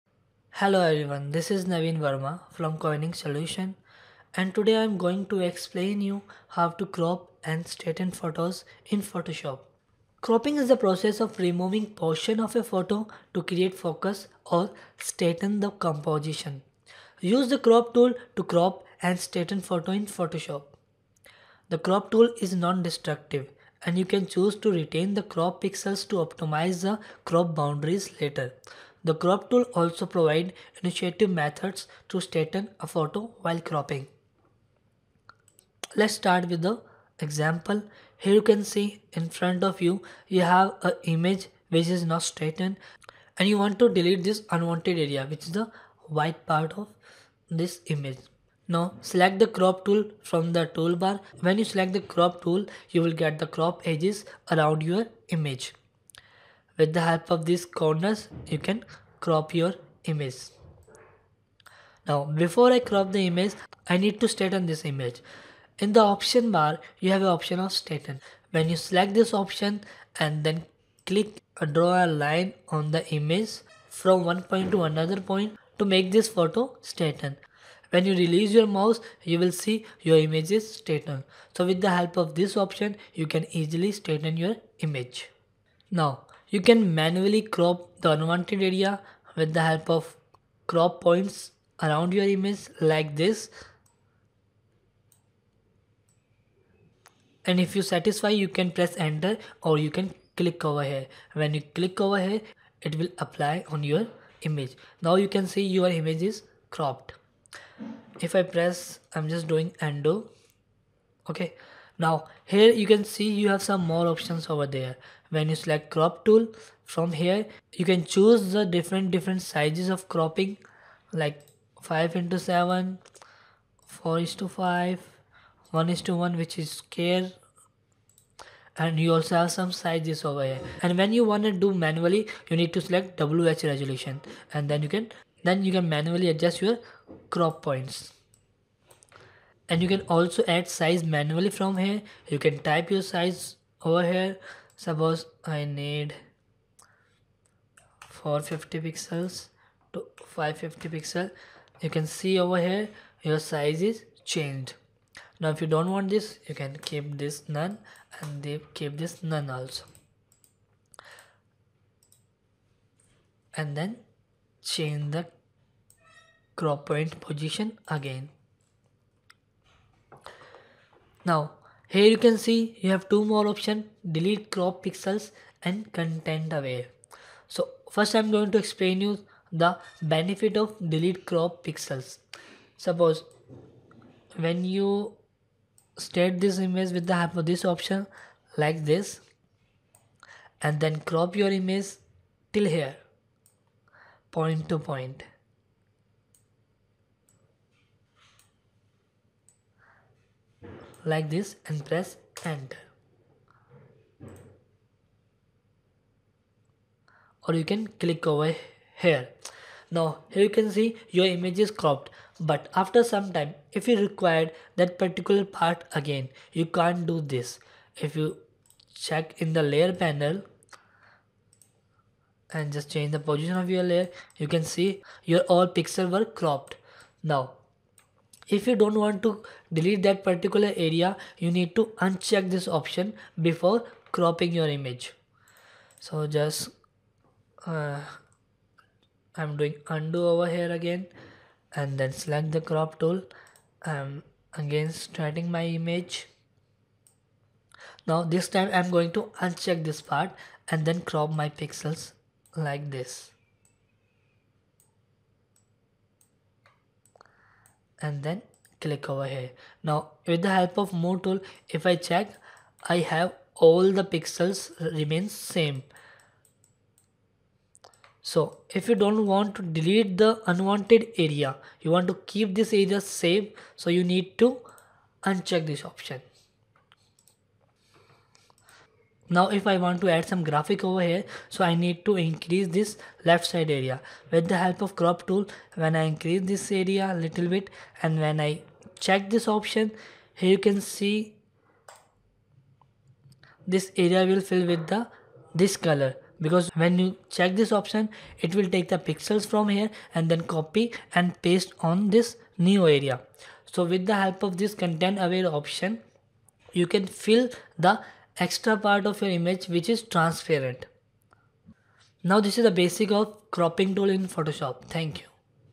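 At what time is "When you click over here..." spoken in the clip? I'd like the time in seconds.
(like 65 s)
101 s.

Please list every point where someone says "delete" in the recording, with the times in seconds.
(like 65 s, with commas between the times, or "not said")
43 s, 174 s, 180 s, 229 s, 269 s.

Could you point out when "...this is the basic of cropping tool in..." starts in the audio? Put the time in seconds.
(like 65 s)
312 s.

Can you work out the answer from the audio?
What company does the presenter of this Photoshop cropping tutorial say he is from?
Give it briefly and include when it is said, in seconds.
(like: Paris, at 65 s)
Koenig Solution, at 2 s.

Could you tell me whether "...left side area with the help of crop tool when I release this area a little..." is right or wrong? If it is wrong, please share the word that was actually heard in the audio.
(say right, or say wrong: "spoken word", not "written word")
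wrong: "increase", not "release".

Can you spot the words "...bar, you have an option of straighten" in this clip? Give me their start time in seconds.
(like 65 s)
66 s.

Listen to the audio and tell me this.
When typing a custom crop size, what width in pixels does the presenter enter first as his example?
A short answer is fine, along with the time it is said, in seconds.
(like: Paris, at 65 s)
450 pixels, at 148 s.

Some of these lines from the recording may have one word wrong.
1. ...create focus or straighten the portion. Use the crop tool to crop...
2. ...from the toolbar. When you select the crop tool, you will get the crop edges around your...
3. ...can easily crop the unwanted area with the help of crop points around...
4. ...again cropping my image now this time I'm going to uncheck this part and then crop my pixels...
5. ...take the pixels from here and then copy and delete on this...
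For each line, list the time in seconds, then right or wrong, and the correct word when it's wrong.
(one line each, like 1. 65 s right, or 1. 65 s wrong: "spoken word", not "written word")
1. 13 s wrong: "composition", not "portion"
2. 50 s right
3. 86 s wrong: "manually", not "easily"
4. 244 s wrong: "starting", not "cropping"
5. 298 s wrong: "paste", not "delete".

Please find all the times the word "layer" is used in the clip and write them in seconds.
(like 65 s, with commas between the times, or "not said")
219 s, 223 s.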